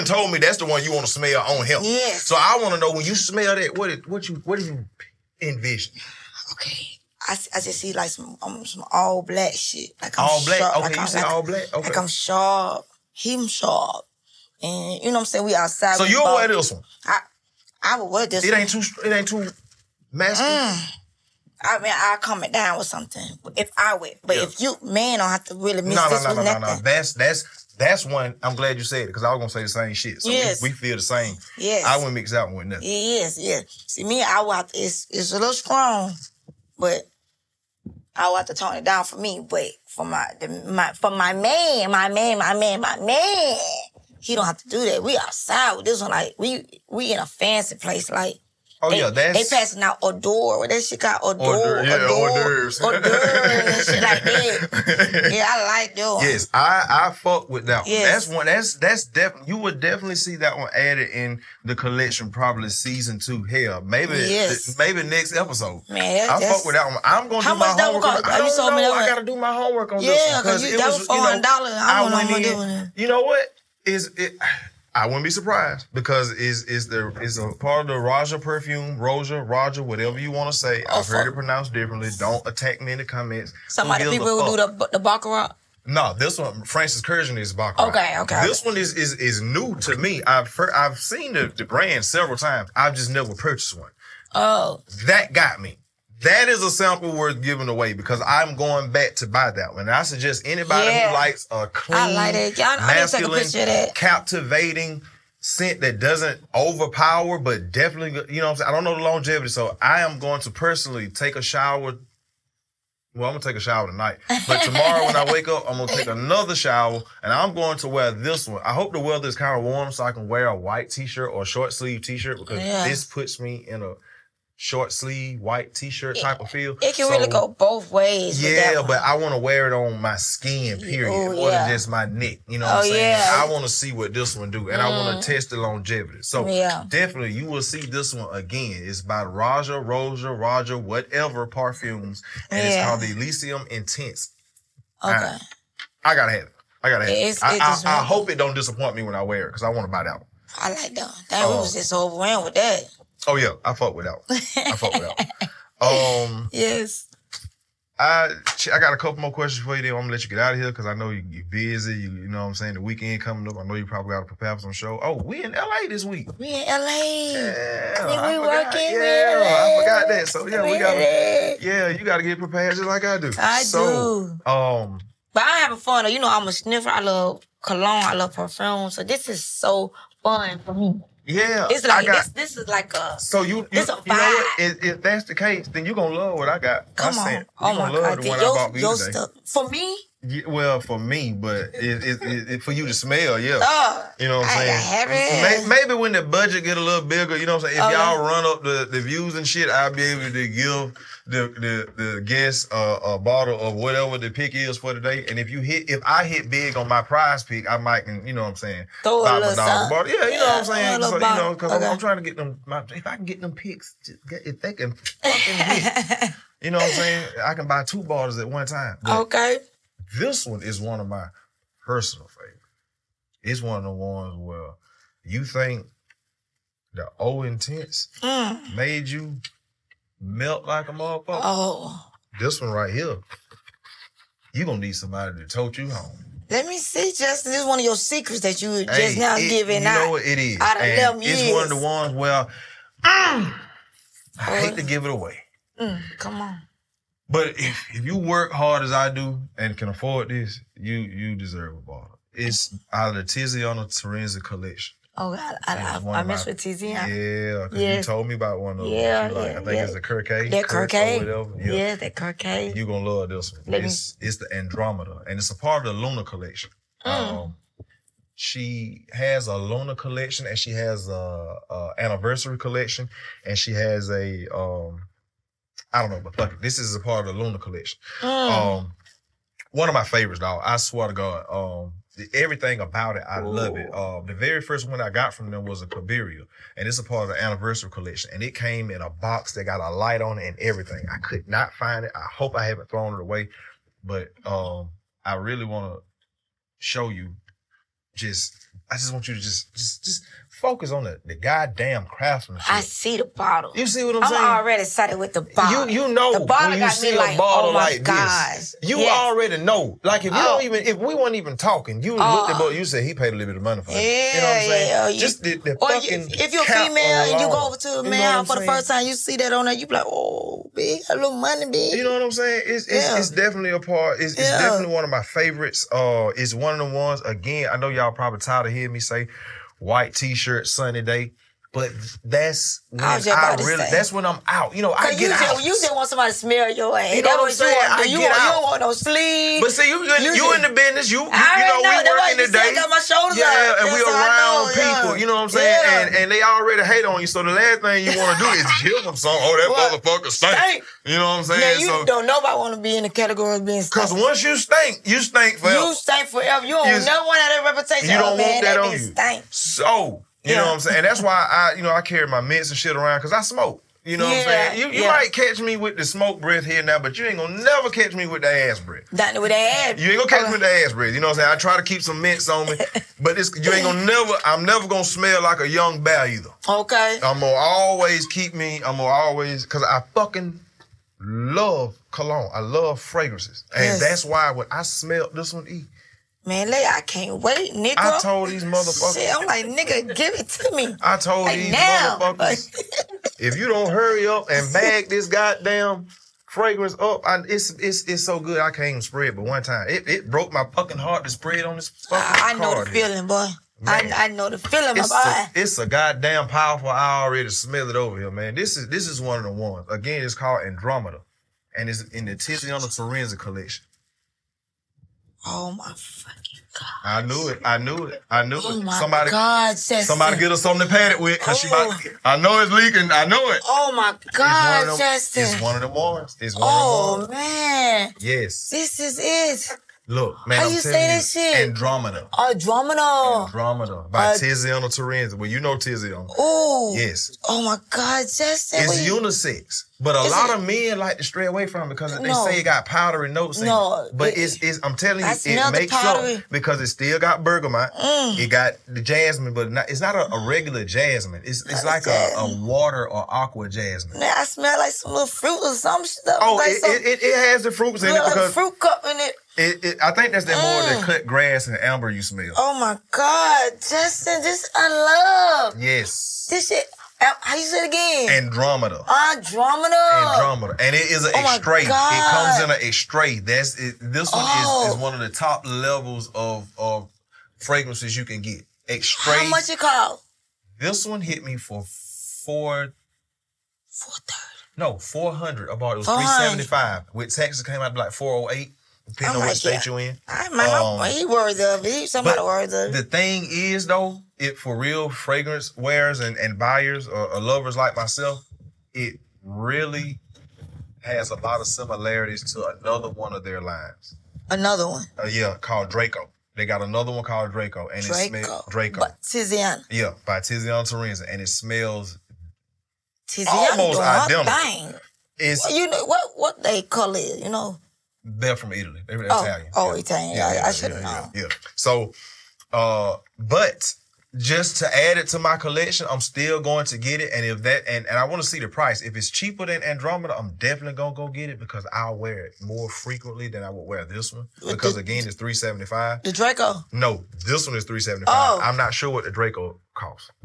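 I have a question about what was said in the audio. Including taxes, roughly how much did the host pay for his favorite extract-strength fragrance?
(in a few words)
408.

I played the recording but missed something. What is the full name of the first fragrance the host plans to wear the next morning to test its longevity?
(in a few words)
Elysium Intense.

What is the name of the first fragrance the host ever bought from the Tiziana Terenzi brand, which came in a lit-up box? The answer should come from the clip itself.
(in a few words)
Cabiria.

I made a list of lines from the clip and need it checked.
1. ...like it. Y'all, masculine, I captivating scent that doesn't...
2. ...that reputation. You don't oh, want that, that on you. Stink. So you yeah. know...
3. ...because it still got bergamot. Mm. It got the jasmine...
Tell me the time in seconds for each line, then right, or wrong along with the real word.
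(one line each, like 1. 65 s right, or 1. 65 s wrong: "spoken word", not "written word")
1. 102 s right
2. 357 s right
3. 446 s right.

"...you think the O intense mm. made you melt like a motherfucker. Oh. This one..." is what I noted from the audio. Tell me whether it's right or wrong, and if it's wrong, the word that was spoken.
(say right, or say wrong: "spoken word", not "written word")
right.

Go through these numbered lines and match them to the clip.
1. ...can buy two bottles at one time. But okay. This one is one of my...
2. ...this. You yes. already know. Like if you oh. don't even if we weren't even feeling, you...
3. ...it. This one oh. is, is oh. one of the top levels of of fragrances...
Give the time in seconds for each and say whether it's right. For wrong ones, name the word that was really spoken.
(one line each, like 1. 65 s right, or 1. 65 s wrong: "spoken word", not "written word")
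1. 217 s right
2. 308 s wrong: "talking", not "feeling"
3. 473 s right.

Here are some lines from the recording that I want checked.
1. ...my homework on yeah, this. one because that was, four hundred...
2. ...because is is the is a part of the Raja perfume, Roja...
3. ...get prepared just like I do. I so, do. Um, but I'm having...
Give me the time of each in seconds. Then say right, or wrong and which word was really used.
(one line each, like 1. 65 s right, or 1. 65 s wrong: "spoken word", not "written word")
1. 69 s right
2. 75 s right
3. 172 s right.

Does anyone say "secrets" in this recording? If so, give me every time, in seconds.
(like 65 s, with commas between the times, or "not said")
237 s.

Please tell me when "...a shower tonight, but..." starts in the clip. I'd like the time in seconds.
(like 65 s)
113 s.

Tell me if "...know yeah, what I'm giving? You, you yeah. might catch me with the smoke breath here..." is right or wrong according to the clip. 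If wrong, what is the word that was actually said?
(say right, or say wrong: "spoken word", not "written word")
wrong: "saying", not "giving".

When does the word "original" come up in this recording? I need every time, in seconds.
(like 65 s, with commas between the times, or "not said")
not said.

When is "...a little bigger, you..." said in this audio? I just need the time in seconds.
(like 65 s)
196 s.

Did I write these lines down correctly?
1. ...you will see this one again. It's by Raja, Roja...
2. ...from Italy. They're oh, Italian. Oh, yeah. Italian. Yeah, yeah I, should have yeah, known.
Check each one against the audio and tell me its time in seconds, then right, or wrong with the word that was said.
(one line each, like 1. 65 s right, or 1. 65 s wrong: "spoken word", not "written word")
1. 137 s right
2. 518 s right.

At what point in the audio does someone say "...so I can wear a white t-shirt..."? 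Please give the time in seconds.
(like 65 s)
119 s.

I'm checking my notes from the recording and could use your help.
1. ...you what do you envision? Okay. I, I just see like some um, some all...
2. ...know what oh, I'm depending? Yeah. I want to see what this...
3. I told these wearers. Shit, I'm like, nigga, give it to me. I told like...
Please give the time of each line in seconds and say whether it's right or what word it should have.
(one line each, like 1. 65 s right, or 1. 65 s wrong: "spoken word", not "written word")
1. 4 s right
2. 132 s wrong: "saying", not "depending"
3. 387 s wrong: "motherfuckers", not "wearers".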